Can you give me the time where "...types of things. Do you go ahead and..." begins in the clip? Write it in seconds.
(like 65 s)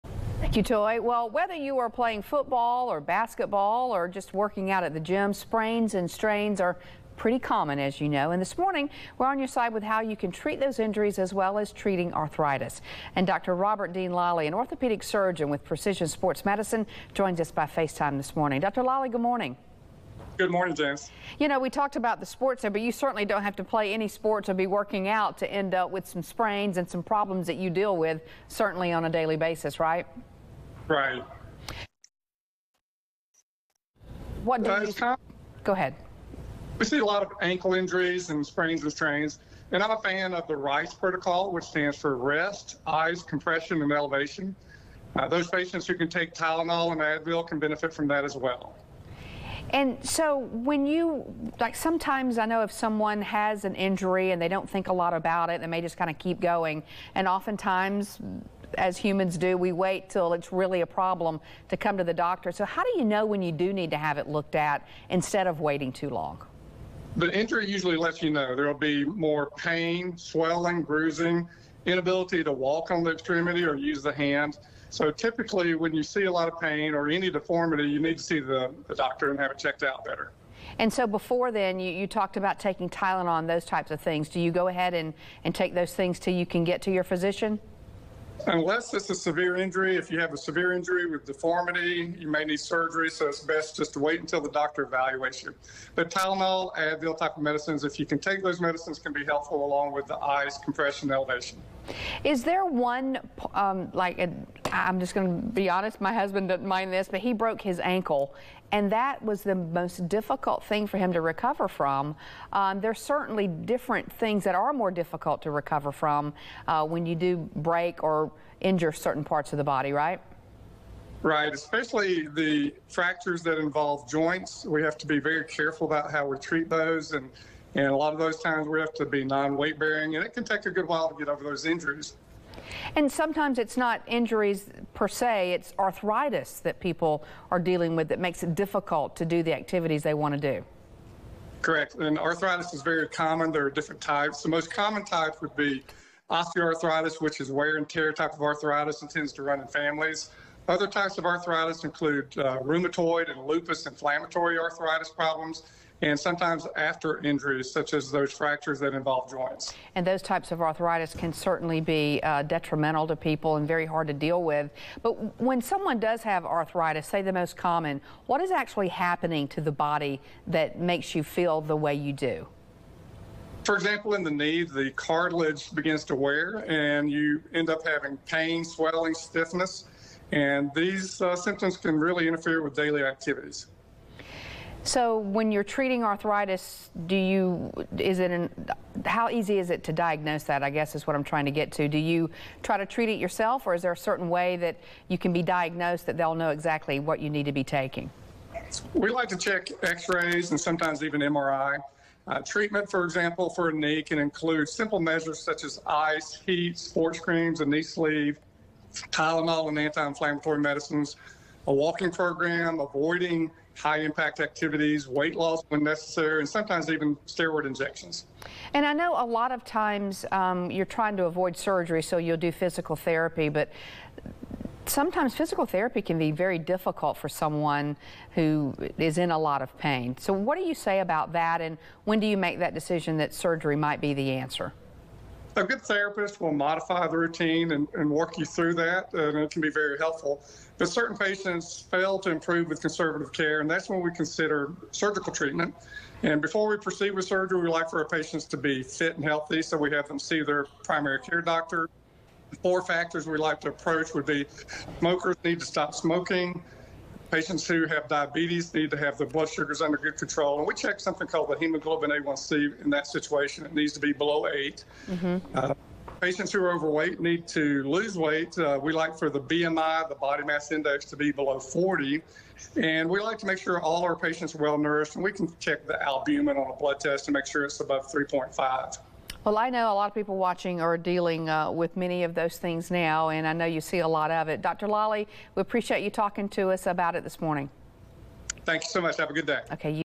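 83 s.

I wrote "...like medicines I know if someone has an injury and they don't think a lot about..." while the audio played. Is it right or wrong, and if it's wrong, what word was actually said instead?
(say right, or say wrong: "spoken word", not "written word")
wrong: "sometimes", not "medicines".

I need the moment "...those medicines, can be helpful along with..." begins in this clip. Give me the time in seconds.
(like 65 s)
98 s.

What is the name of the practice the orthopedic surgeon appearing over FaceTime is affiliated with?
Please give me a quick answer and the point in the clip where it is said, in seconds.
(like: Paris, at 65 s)
Precision Sports Medicine, at 15 s.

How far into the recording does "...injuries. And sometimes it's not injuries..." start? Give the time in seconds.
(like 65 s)
131 s.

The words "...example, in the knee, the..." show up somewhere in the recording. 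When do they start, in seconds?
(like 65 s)
173 s.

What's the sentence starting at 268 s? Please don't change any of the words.
Uh, we like for the BMI, the body mass index, to be below 40.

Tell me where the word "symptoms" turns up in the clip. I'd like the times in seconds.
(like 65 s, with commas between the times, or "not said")
181 s.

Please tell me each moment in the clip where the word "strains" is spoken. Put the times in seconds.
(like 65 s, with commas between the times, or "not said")
6 s, 38 s.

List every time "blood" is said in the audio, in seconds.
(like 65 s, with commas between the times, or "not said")
259 s, 276 s.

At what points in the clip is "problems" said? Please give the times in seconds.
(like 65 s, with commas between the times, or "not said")
27 s, 60 s, 155 s.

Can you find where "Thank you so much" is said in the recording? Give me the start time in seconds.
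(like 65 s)
288 s.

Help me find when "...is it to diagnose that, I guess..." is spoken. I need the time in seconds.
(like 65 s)
189 s.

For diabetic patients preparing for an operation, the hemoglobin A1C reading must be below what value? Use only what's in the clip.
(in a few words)
8.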